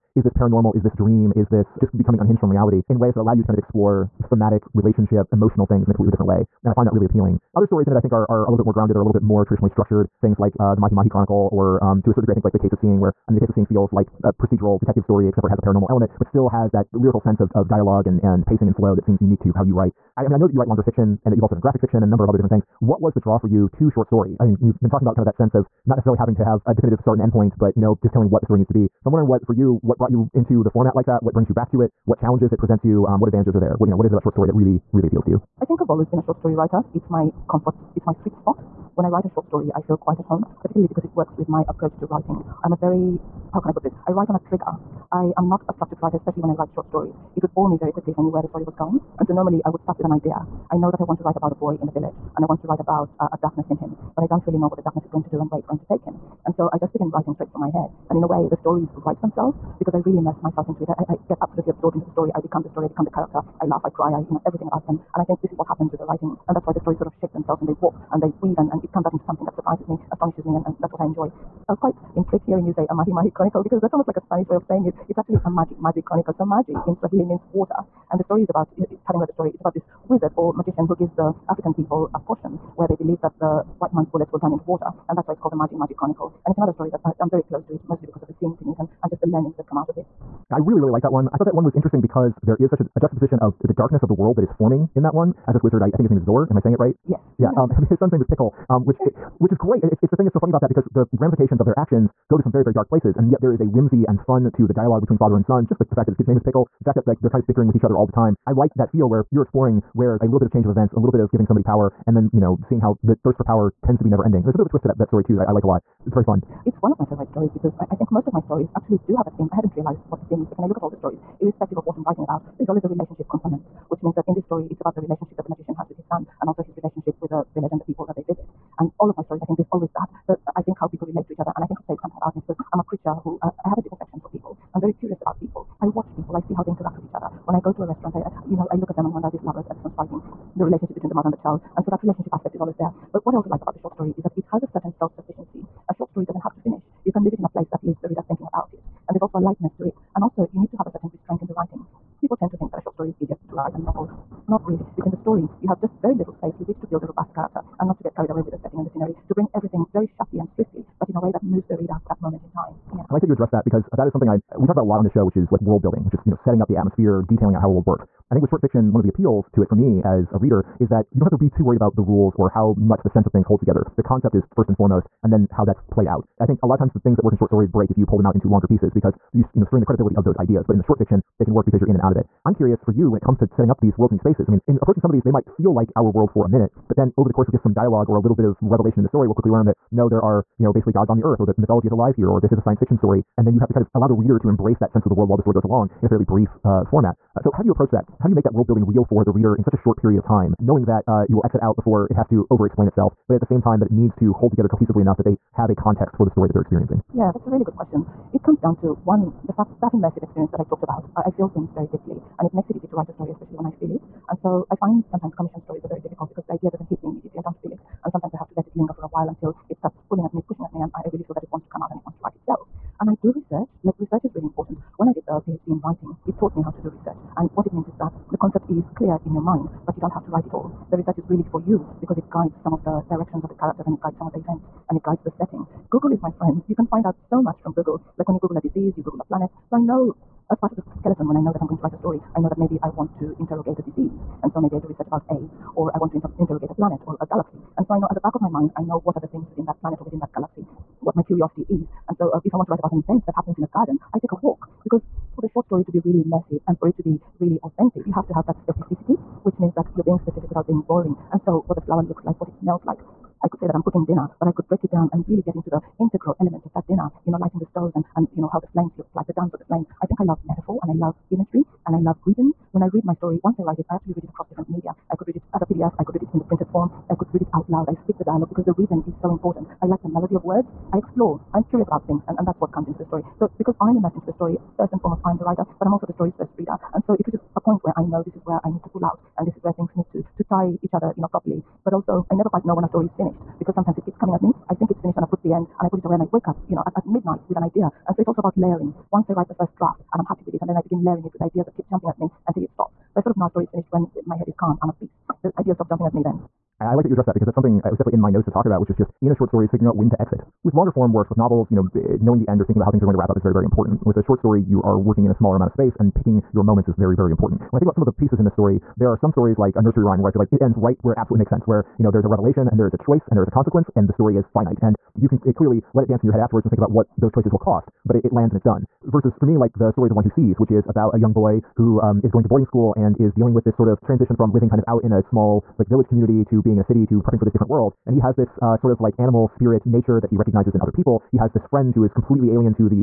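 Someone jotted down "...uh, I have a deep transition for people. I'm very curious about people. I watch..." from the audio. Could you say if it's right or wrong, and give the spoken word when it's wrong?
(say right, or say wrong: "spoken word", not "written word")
wrong: "affection", not "transition".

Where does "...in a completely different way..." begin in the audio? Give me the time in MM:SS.
00:05.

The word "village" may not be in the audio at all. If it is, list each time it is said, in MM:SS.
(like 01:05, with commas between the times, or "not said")
00:51, 02:07, 05:35.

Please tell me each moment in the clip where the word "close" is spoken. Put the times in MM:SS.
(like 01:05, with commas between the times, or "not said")
01:27.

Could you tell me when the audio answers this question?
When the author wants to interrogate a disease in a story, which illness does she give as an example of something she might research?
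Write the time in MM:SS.
04:05.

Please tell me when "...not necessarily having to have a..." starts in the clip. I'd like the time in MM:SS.
00:25.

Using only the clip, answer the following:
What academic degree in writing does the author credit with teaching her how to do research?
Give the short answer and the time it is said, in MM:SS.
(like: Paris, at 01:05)
PhD, at 03:45.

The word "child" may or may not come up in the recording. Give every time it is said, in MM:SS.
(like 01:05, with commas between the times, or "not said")
02:21.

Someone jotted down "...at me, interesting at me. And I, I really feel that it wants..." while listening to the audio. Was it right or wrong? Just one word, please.
wrong.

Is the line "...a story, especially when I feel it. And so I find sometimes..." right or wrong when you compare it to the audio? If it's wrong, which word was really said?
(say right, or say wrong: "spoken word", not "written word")
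right.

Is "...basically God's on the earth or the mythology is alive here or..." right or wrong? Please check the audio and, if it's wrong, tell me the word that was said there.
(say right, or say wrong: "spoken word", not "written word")
right.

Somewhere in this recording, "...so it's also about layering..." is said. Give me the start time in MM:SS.
04:58.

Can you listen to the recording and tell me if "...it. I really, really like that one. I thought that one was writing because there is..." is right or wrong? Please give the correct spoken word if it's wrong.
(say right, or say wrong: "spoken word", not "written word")
wrong: "interesting", not "writing".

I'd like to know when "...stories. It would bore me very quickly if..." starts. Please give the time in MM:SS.
00:46.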